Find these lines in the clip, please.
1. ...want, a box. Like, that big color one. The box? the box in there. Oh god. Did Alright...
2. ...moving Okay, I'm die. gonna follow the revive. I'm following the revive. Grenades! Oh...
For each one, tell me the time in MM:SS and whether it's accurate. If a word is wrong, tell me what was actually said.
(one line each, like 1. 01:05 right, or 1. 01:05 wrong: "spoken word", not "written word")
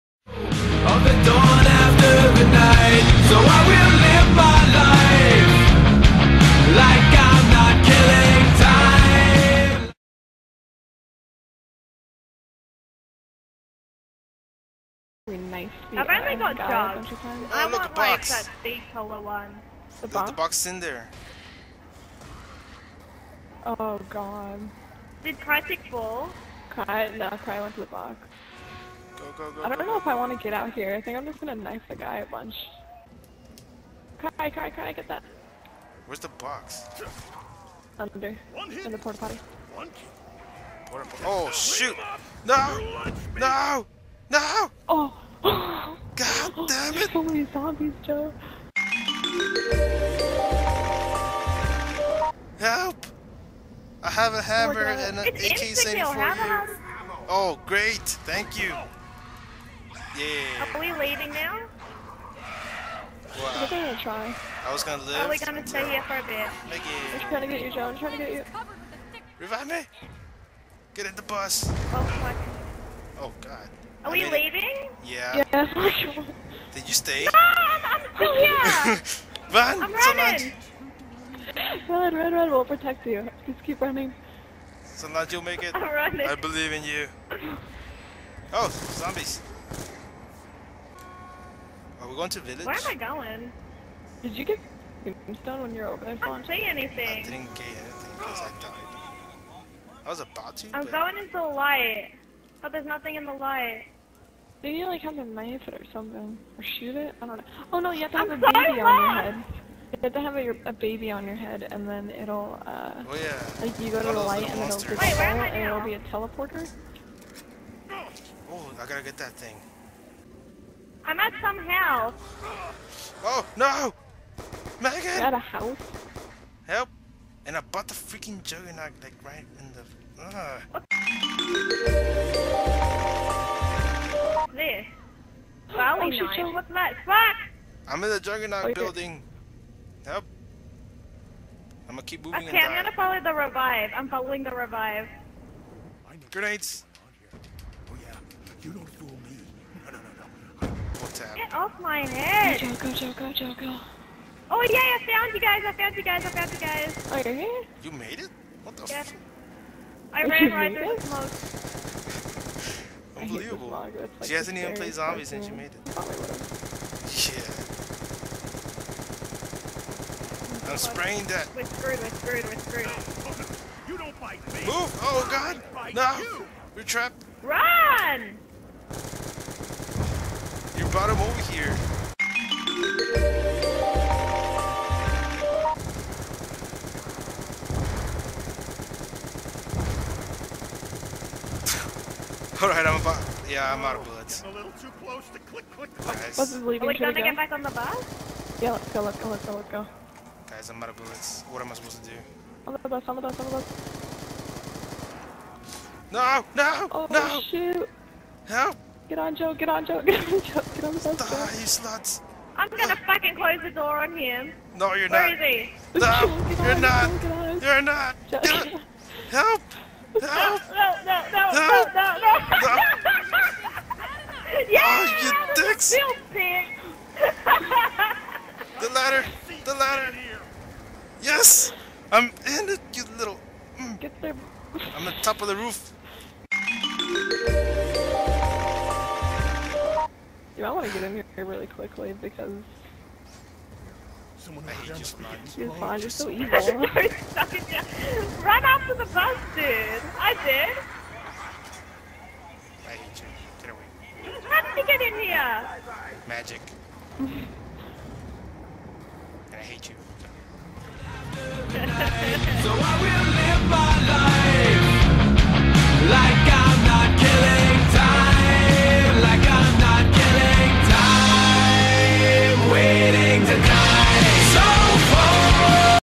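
1. 00:17 wrong: "Kai", not "Alright"
2. 02:22 right.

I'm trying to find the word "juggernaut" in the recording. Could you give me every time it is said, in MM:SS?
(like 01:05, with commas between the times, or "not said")
02:08, 02:18.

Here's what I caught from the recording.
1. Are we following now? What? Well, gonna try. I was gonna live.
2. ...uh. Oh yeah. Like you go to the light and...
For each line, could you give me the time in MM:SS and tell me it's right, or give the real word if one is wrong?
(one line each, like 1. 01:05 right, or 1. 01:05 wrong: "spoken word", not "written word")
1. 01:00 wrong: "leaving", not "following"
2. 01:52 right.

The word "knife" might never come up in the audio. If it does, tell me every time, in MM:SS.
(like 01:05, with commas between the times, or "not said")
00:31, 01:45.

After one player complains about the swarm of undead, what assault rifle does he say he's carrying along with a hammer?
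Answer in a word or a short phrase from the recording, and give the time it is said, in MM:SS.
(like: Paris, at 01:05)
AK-74, at 00:55.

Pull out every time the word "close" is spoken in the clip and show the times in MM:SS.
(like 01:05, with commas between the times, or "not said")
03:15, 03:33.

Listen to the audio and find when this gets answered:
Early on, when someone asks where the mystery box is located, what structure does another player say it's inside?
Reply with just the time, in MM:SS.
00:38.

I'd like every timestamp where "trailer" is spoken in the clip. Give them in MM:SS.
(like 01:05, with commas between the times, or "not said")
not said.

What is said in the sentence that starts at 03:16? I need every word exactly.
Are we Should gonna get back on the bus?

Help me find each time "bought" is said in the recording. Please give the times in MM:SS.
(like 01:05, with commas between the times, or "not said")
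02:07.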